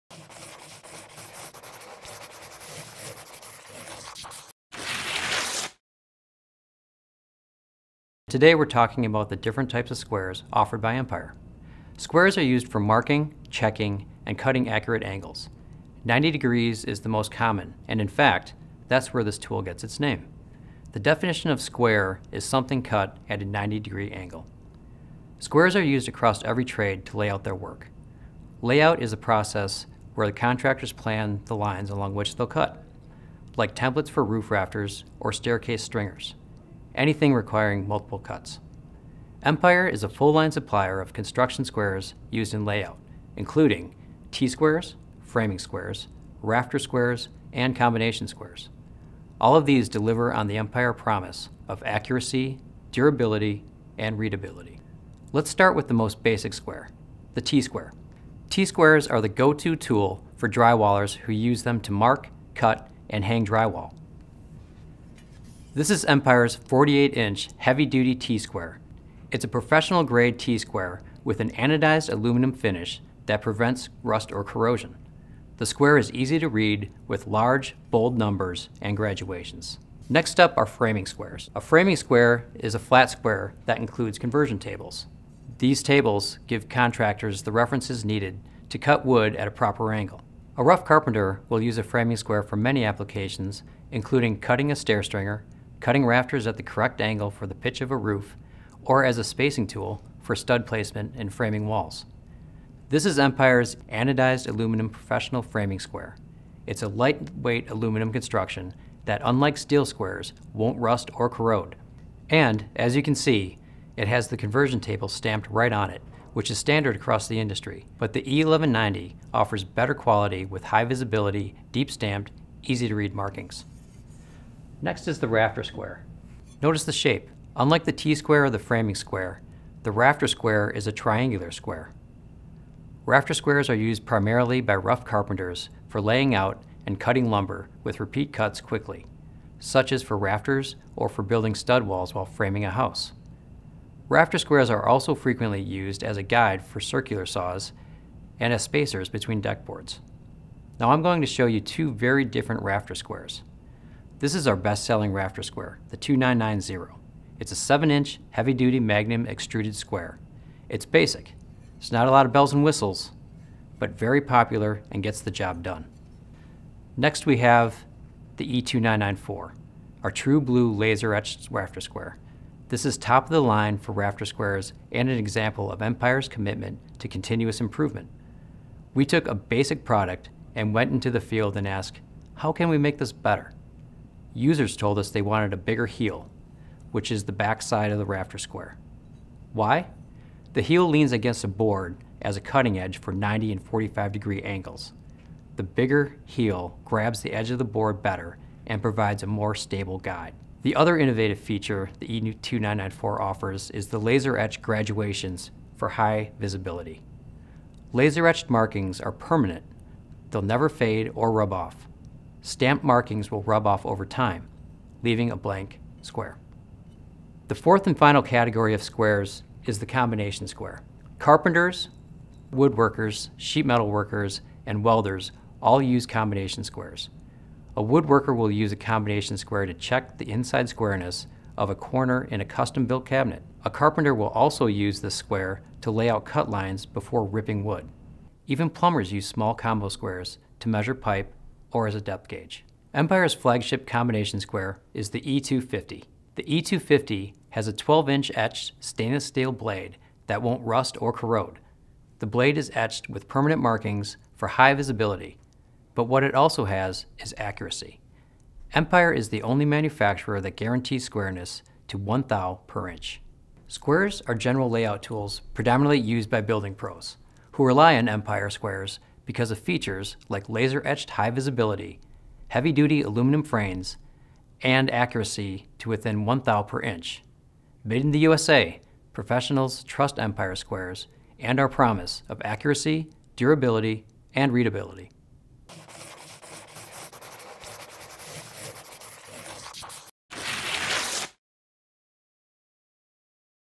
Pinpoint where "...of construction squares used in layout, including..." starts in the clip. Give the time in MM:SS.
00:40.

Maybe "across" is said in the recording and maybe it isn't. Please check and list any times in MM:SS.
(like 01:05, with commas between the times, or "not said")
00:26, 01:56.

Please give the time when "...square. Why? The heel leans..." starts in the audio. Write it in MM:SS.
03:08.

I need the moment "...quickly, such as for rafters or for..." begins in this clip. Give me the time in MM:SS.
02:18.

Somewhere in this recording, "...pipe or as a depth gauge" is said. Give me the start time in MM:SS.
04:00.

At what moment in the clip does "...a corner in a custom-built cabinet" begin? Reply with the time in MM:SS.
03:51.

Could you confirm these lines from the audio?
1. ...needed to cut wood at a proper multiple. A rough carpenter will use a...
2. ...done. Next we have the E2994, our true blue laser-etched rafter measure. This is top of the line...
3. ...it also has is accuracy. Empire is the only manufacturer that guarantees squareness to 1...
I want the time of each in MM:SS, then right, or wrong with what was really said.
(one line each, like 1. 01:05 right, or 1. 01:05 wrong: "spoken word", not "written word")
1. 01:28 wrong: "angle", not "multiple"
2. 02:45 wrong: "square", not "measure"
3. 04:16 right.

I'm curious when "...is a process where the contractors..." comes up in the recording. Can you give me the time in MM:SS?
00:29.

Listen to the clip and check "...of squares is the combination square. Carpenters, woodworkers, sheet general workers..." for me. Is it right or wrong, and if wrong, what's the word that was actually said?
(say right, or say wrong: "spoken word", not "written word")
wrong: "metal", not "general".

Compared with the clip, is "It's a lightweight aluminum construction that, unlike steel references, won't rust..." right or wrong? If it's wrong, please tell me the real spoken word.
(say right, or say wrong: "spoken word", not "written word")
wrong: "squares", not "references".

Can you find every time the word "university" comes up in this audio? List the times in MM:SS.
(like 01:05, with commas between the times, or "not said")
not said.